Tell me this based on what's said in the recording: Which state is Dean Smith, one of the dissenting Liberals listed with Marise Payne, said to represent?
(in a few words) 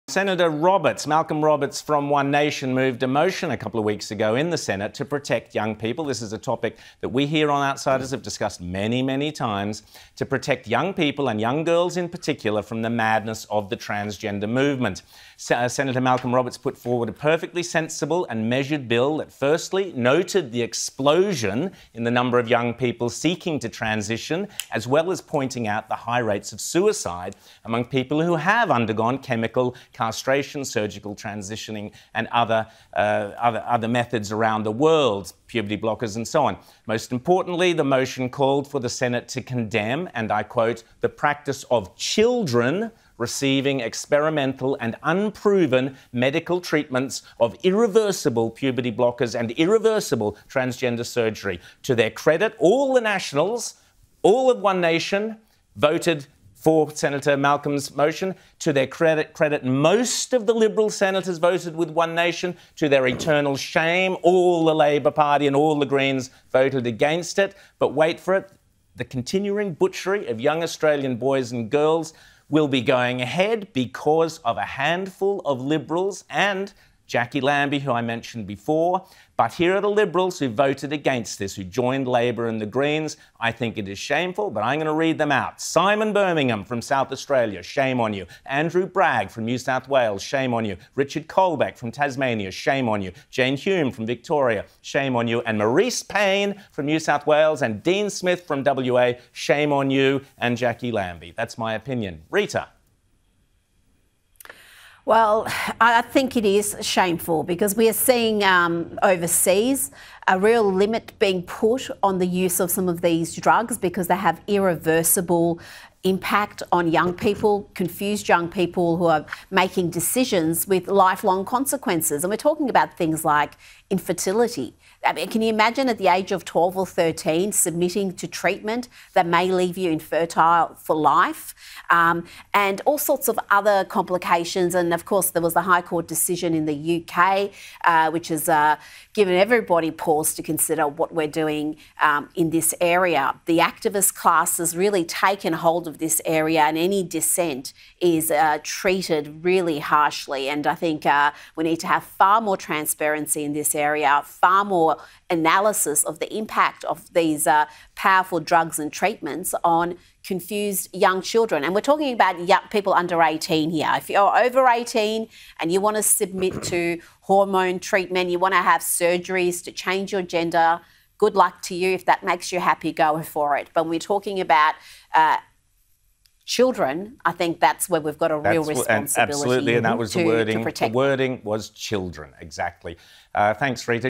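WA.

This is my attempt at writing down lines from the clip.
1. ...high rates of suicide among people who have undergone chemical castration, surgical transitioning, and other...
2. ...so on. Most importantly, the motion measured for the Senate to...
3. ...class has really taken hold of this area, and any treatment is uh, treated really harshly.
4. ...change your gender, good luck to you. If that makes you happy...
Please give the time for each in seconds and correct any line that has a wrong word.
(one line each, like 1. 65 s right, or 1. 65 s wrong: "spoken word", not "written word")
1. 25 s right
2. 36 s wrong: "called", not "measured"
3. 144 s wrong: "dissent", not "treatment"
4. 169 s right.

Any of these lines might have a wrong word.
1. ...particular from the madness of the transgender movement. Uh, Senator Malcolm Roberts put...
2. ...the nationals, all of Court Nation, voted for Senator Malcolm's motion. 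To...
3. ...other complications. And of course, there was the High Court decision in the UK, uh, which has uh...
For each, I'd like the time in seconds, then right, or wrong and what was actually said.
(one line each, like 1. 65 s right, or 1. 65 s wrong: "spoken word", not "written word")
1. 12 s right
2. 52 s wrong: "One", not "Court"
3. 133 s right.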